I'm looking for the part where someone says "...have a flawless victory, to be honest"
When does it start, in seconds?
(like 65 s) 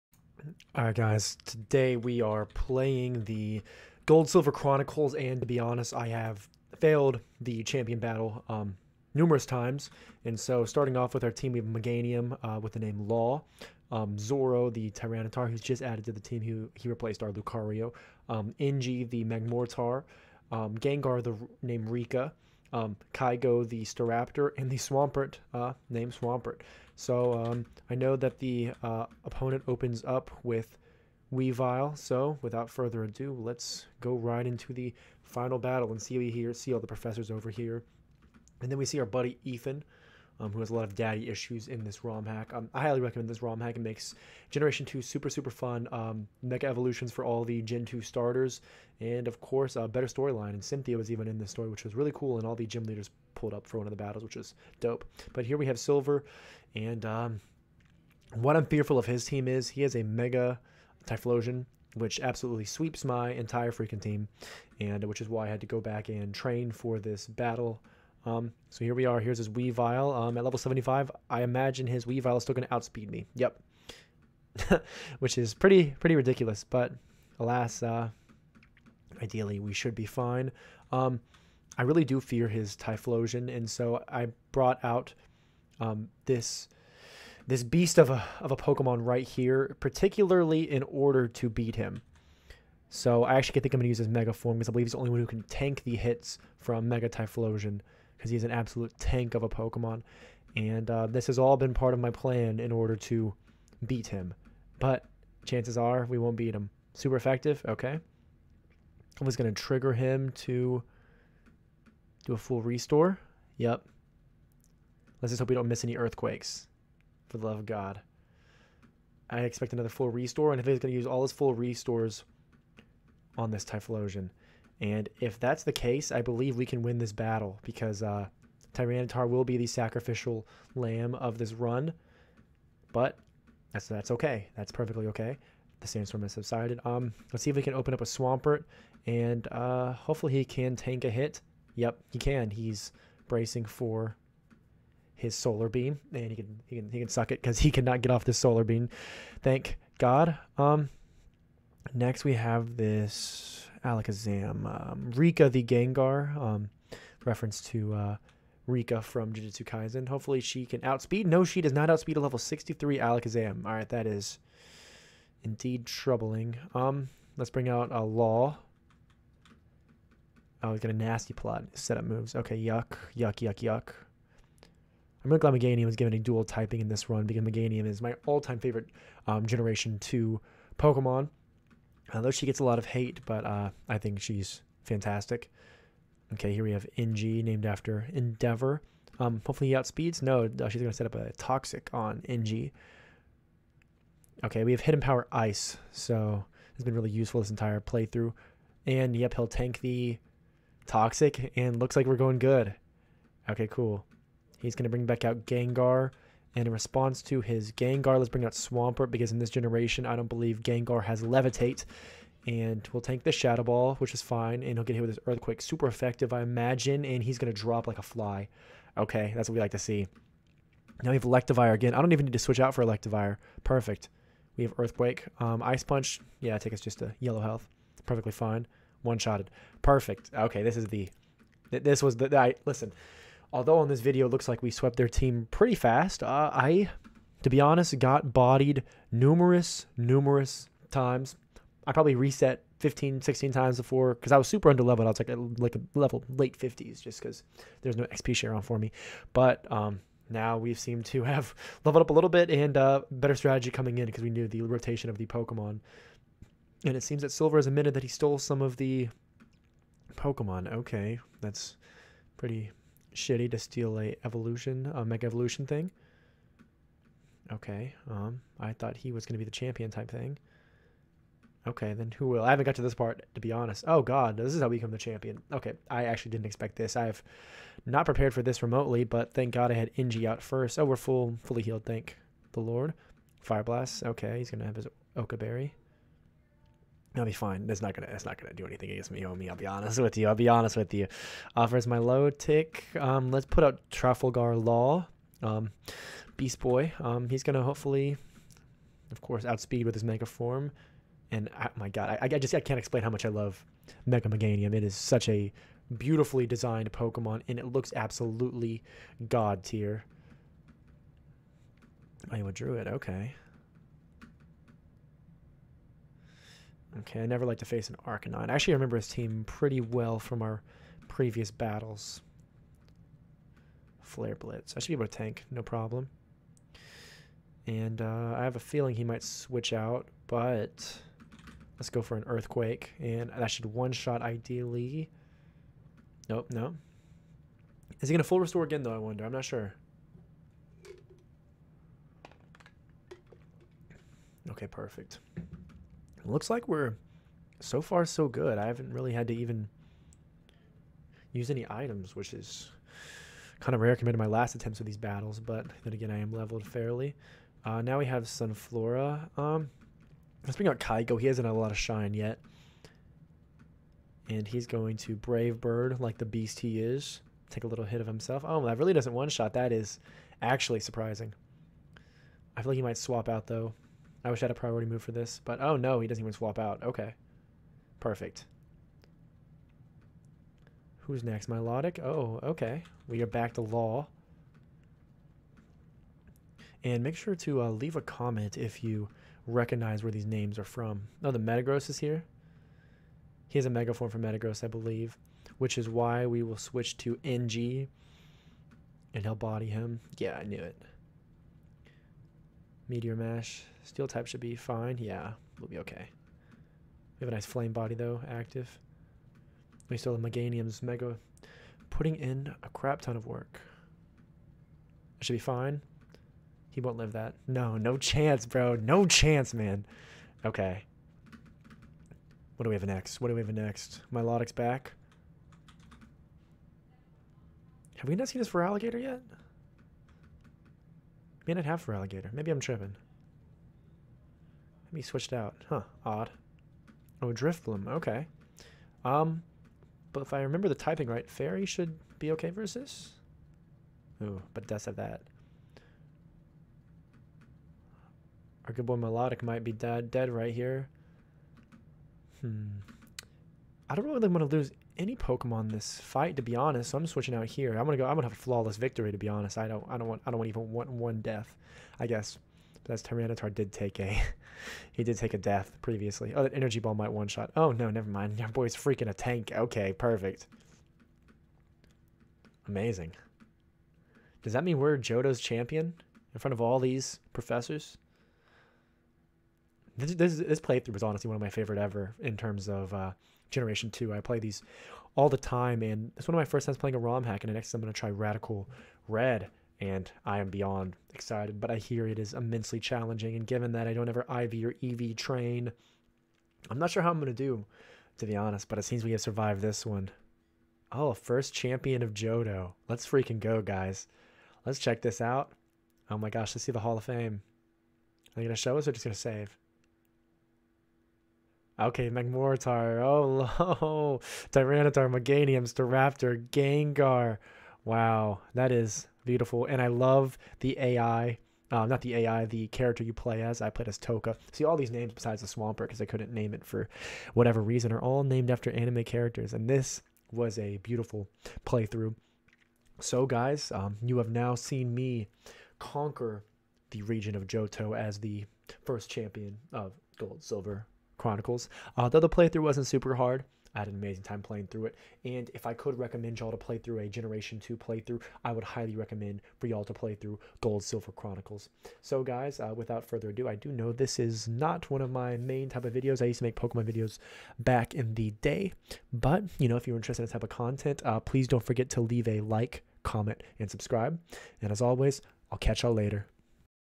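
458 s.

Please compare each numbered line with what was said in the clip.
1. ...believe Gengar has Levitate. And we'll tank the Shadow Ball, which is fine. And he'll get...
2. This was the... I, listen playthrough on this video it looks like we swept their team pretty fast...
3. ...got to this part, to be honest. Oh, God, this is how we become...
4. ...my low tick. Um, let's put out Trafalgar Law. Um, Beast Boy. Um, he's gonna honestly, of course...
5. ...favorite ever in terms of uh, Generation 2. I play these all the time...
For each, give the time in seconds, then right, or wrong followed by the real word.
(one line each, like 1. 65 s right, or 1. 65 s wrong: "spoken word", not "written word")
1. 210 s right
2. 231 s wrong: "although", not "playthrough"
3. 272 s right
4. 291 s wrong: "hopefully", not "honestly"
5. 481 s right.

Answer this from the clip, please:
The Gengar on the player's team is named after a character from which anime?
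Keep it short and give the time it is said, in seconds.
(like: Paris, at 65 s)
Jujutsu Kaisen, at 159 s.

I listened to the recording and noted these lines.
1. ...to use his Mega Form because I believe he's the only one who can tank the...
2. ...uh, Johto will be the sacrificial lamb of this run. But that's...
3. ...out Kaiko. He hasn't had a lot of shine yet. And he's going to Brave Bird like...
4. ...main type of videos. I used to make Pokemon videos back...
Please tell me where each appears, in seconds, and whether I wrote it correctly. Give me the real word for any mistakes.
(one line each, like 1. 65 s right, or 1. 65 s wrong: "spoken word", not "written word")
1. 93 s right
2. 128 s wrong: "Tyranitar", not "Johto"
3. 360 s right
4. 555 s right.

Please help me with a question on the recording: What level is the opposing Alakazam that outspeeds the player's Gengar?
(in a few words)
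63.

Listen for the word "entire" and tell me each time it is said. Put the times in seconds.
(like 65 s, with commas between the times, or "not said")
63 s, 197 s.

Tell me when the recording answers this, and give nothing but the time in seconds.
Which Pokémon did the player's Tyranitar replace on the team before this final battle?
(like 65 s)
17 s.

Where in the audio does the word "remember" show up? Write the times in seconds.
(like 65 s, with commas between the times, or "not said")
318 s, 440 s.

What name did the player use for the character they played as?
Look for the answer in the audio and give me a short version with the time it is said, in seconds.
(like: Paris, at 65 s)
Toka, at 523 s.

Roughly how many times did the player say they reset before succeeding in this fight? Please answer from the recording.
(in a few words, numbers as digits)
15 or 16.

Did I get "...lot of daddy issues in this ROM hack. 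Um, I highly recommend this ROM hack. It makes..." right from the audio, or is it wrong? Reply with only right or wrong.
right.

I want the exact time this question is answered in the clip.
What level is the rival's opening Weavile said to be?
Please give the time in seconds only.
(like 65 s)
70 s.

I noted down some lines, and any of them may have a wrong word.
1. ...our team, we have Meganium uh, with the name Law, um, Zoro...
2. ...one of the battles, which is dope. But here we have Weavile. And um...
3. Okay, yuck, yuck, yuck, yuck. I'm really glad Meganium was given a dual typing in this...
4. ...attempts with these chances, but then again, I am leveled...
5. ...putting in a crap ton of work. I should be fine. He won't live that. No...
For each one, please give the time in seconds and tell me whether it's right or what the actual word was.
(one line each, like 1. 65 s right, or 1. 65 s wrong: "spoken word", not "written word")
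1. 11 s right
2. 53 s wrong: "Silver", not "Weavile"
3. 172 s right
4. 354 s wrong: "battles", not "chances"
5. 411 s right.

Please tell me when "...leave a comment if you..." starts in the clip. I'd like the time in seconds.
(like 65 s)
387 s.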